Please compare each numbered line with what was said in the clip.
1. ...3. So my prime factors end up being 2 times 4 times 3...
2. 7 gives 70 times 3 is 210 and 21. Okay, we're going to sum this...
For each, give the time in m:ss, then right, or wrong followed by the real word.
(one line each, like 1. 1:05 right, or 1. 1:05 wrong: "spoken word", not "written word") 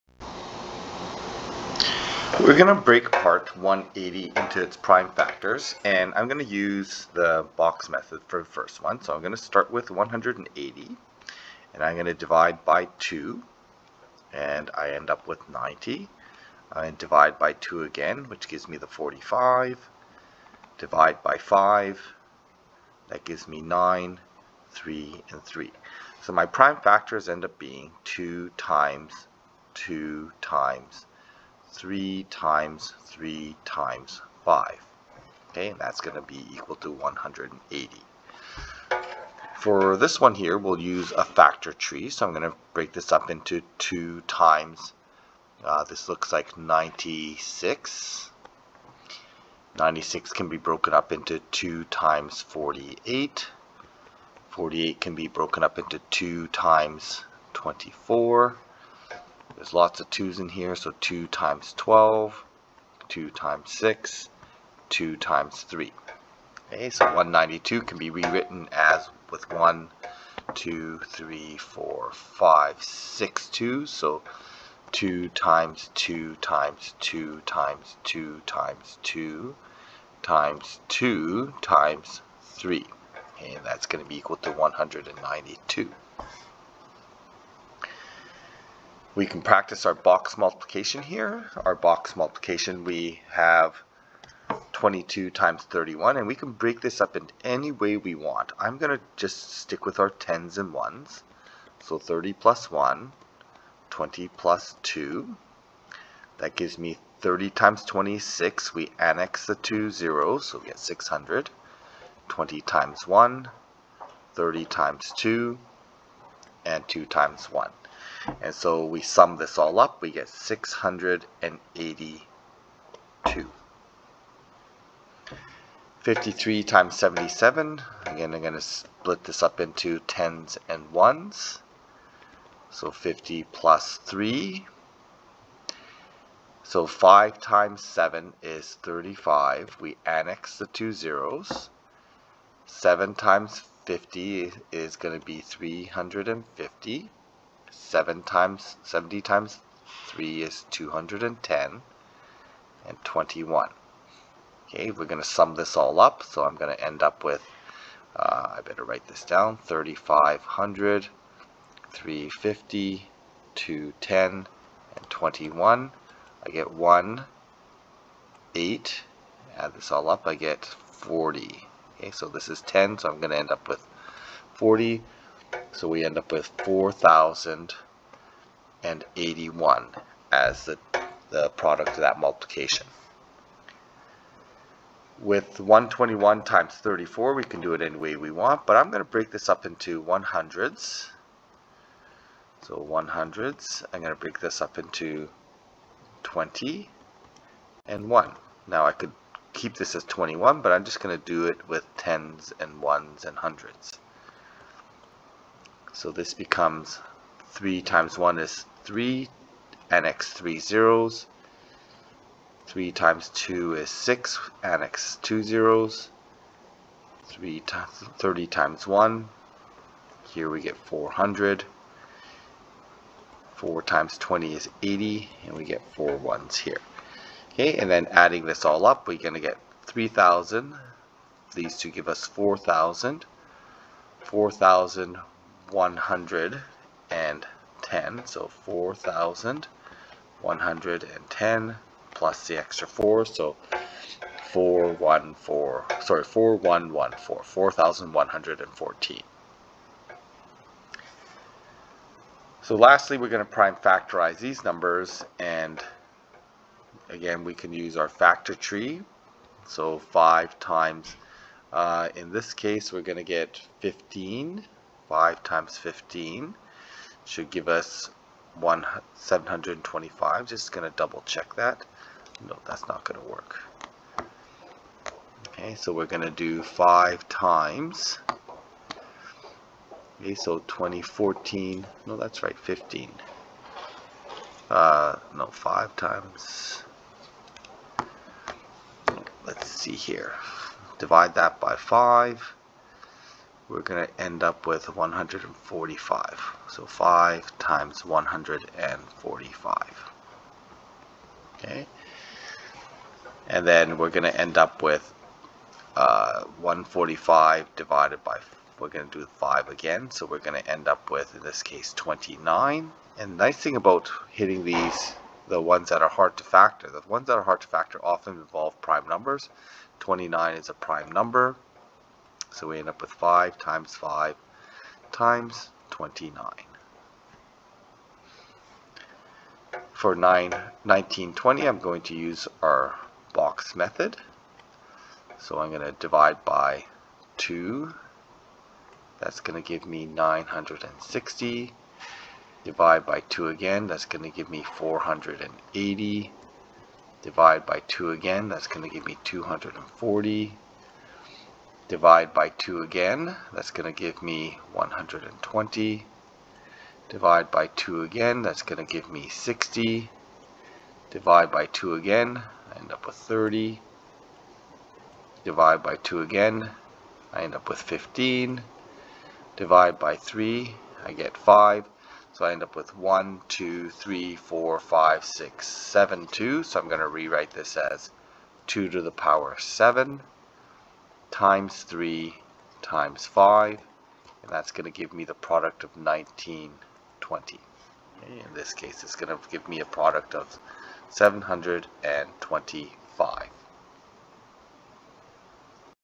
1. 0:25 wrong: "2", not "4"
2. 2:27 wrong: "times", not "gives".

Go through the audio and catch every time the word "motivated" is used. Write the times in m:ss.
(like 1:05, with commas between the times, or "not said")
not said.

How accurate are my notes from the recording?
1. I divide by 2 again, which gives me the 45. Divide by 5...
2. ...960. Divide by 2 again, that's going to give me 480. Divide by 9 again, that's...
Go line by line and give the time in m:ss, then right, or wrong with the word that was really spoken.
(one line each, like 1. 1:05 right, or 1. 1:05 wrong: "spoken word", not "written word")
1. 0:16 right
2. 5:40 wrong: "2", not "9".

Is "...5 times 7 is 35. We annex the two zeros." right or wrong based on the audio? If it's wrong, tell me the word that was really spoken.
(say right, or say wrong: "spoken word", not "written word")
right.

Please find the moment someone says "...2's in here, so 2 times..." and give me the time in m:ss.
1:00.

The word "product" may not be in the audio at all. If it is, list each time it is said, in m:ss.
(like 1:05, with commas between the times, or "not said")
3:01, 6:25, 6:29.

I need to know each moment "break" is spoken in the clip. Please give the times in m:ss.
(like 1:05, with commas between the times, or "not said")
0:02, 0:42, 1:36, 3:09, 3:14.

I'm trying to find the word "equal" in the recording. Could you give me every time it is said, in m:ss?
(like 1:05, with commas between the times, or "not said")
0:36, 1:24.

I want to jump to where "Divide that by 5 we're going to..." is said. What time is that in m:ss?
4:50.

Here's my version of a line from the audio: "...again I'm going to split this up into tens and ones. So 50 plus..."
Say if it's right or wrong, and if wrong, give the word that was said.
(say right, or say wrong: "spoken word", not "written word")
right.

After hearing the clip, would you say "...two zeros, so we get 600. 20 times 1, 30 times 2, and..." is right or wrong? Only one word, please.
right.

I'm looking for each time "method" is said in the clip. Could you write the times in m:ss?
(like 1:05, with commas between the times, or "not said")
0:07, 5:33.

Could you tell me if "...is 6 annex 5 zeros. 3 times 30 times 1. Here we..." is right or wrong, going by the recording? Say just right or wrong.
wrong.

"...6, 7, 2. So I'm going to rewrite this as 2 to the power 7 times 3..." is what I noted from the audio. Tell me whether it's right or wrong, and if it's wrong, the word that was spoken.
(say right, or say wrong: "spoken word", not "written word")
right.